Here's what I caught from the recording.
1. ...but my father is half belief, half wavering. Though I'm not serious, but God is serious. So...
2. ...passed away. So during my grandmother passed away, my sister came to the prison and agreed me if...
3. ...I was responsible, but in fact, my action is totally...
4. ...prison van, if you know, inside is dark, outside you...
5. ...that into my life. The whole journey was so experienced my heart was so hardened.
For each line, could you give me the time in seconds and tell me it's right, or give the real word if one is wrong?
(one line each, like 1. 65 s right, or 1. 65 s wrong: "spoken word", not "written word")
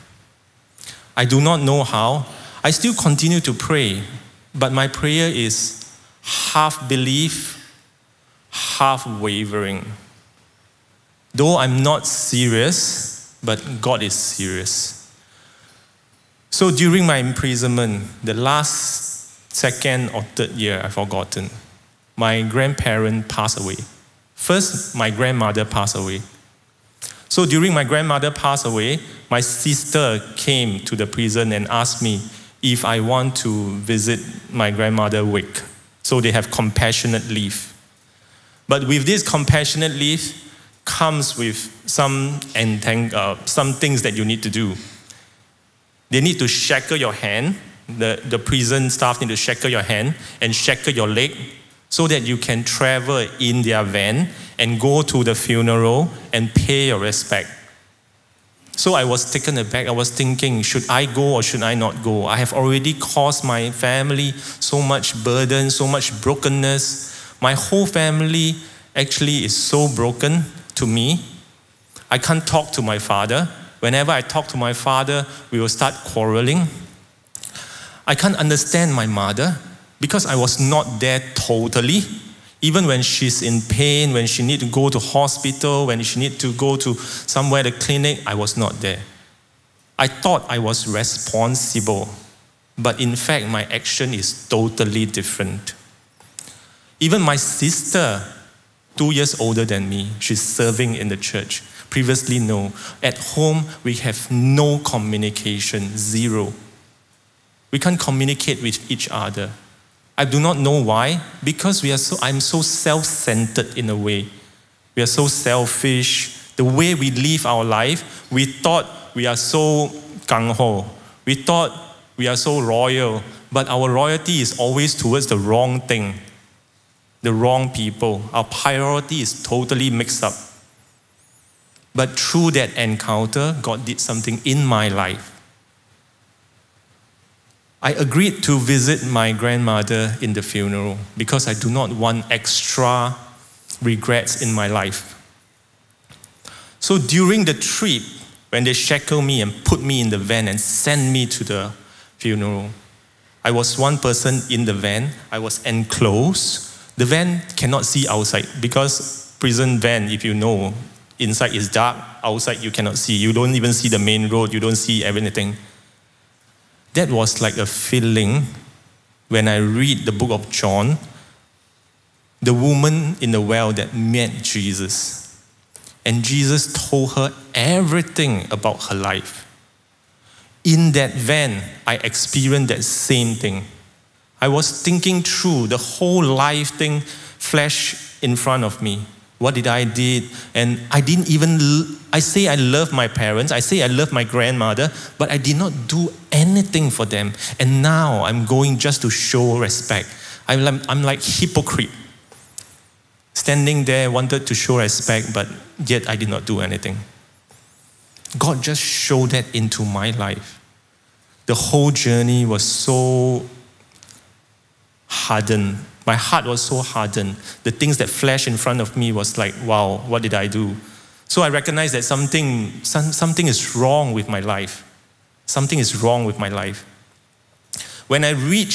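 1. 4 s wrong: "prayer", not "father"
2. 25 s wrong: "asked", not "agreed"
3. 90 s right
4. 159 s right
5. 209 s wrong: "hardened", not "experienced".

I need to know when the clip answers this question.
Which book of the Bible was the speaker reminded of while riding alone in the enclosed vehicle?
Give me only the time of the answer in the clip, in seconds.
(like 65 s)
170 s.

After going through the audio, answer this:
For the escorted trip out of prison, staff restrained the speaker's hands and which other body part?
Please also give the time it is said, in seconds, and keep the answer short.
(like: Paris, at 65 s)
Leg, at 51 s.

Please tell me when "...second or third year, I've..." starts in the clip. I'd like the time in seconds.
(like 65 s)
19 s.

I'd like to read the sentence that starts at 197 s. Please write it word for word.
And now I'm going just to show respect.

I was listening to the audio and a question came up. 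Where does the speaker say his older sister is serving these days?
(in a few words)
Church.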